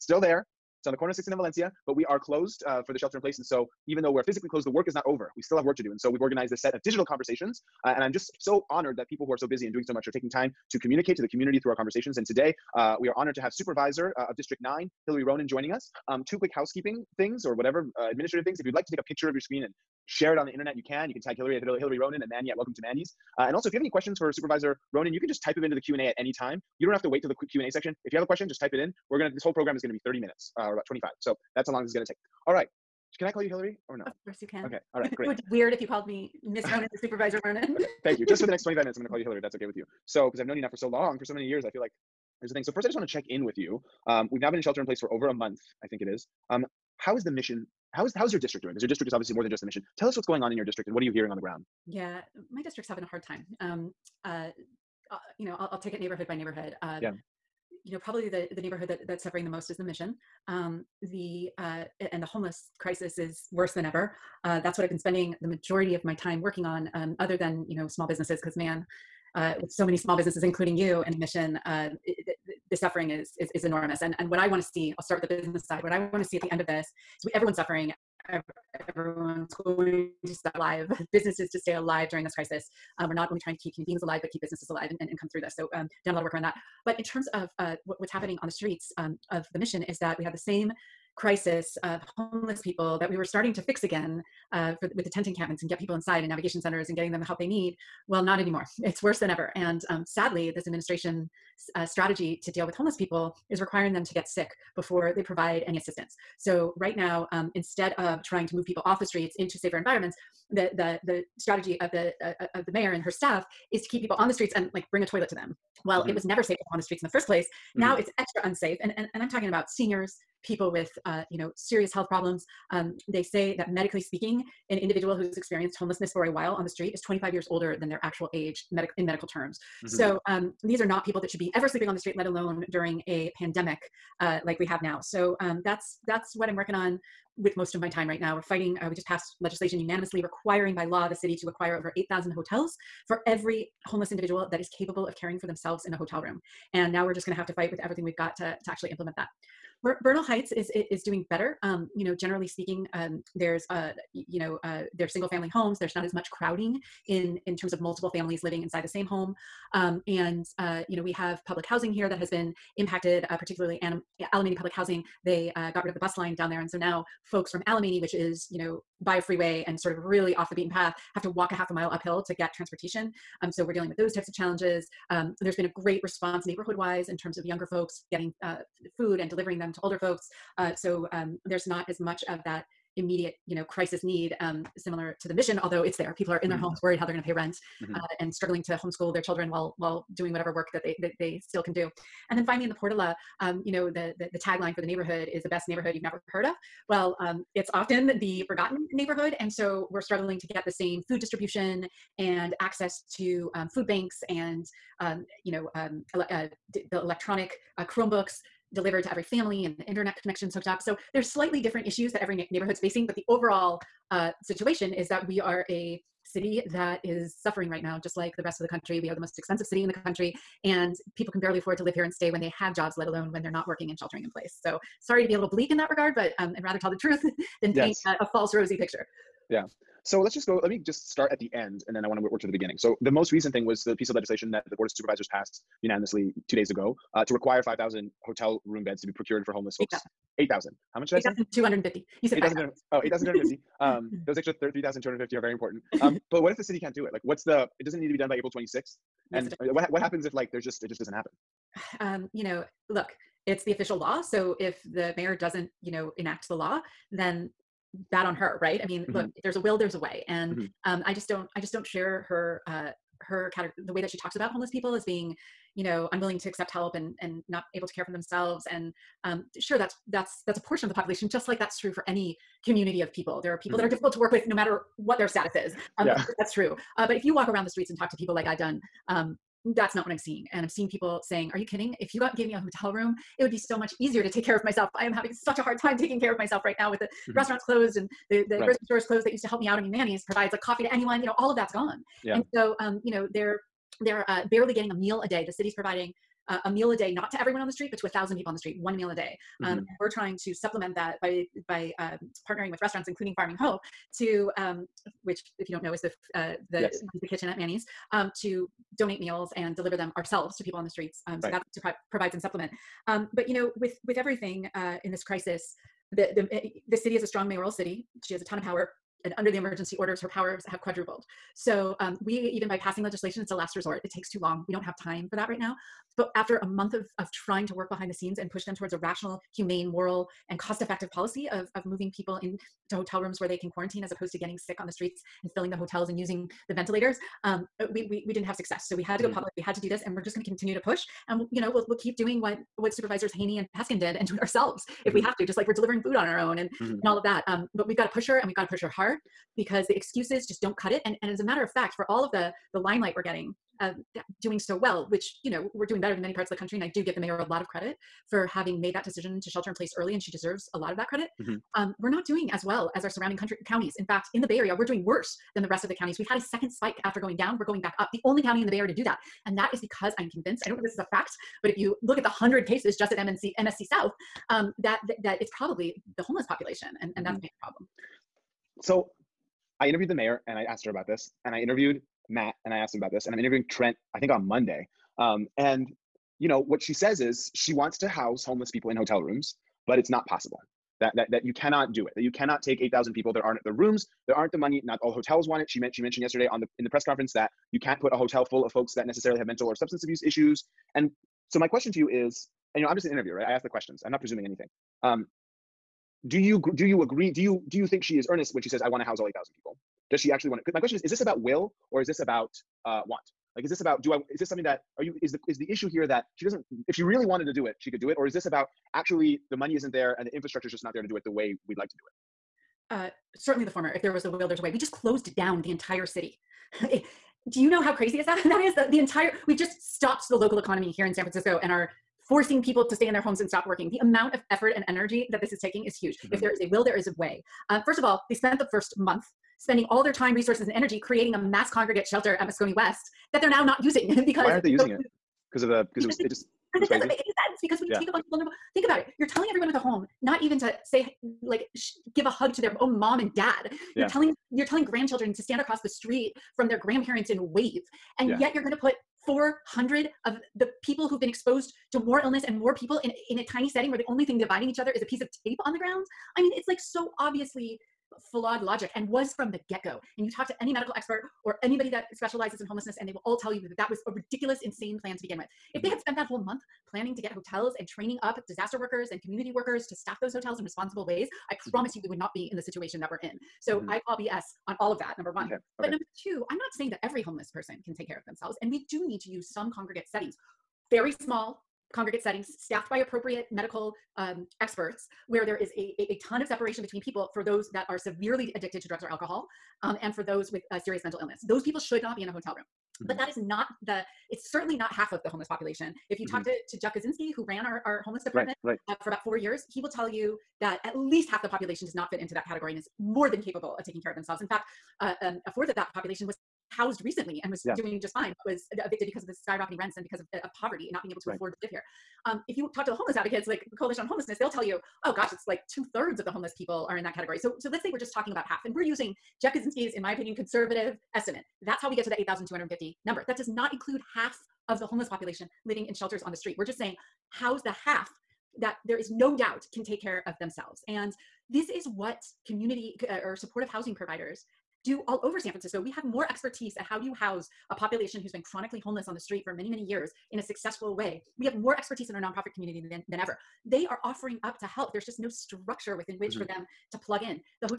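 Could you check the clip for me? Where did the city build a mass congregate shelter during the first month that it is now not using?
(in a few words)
Moscone West.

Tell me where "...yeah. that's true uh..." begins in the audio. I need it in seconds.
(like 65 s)
276 s.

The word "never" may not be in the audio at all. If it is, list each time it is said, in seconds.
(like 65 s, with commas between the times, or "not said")
116 s, 196 s.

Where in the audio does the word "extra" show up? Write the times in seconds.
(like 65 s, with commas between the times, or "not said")
118 s, 244 s.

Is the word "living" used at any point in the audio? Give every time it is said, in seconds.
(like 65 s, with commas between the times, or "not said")
158 s, 535 s.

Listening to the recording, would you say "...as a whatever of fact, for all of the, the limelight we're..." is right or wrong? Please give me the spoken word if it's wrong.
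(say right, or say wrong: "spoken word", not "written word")
wrong: "matter", not "whatever".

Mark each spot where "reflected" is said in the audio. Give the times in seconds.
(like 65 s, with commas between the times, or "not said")
not said.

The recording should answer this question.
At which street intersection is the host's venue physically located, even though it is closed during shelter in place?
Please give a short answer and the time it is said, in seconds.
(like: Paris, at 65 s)
16th and Valencia, at 1 s.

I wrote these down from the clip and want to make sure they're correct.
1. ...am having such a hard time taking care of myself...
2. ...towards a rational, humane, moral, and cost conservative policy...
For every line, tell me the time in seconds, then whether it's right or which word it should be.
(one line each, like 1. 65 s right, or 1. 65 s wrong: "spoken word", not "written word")
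1. 285 s right
2. 328 s wrong: "effective", not "conservative".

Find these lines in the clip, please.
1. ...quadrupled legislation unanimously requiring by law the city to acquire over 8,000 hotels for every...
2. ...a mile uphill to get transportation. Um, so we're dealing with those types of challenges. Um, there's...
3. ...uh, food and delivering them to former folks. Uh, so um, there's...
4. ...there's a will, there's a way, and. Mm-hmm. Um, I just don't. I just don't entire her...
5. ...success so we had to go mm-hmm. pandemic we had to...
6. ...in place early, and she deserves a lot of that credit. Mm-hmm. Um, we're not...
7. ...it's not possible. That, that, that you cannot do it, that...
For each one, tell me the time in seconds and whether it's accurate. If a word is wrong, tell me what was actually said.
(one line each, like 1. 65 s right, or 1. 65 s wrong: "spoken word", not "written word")
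1. 139 s wrong: "passed", not "quadrupled"
2. 171 s right
3. 178 s wrong: "older", not "former"
4. 259 s wrong: "share", not "entire"
5. 338 s wrong: "public", not "pandemic"
6. 359 s right
7. 389 s right.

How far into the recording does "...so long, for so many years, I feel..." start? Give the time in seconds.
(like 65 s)
40 s.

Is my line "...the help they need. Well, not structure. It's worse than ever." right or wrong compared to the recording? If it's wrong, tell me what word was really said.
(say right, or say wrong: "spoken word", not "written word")
wrong: "anymore", not "structure".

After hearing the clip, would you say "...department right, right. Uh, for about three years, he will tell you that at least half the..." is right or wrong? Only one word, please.
wrong.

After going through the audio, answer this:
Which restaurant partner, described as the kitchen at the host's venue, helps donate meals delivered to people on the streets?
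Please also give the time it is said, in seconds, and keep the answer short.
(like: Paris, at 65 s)
Farming Hope, at 303 s.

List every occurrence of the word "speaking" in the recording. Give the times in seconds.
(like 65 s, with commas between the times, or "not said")
124 s, 152 s.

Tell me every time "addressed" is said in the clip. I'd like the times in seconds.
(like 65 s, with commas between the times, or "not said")
not said.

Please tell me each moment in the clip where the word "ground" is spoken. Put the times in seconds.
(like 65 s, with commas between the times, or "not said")
51 s, 465 s.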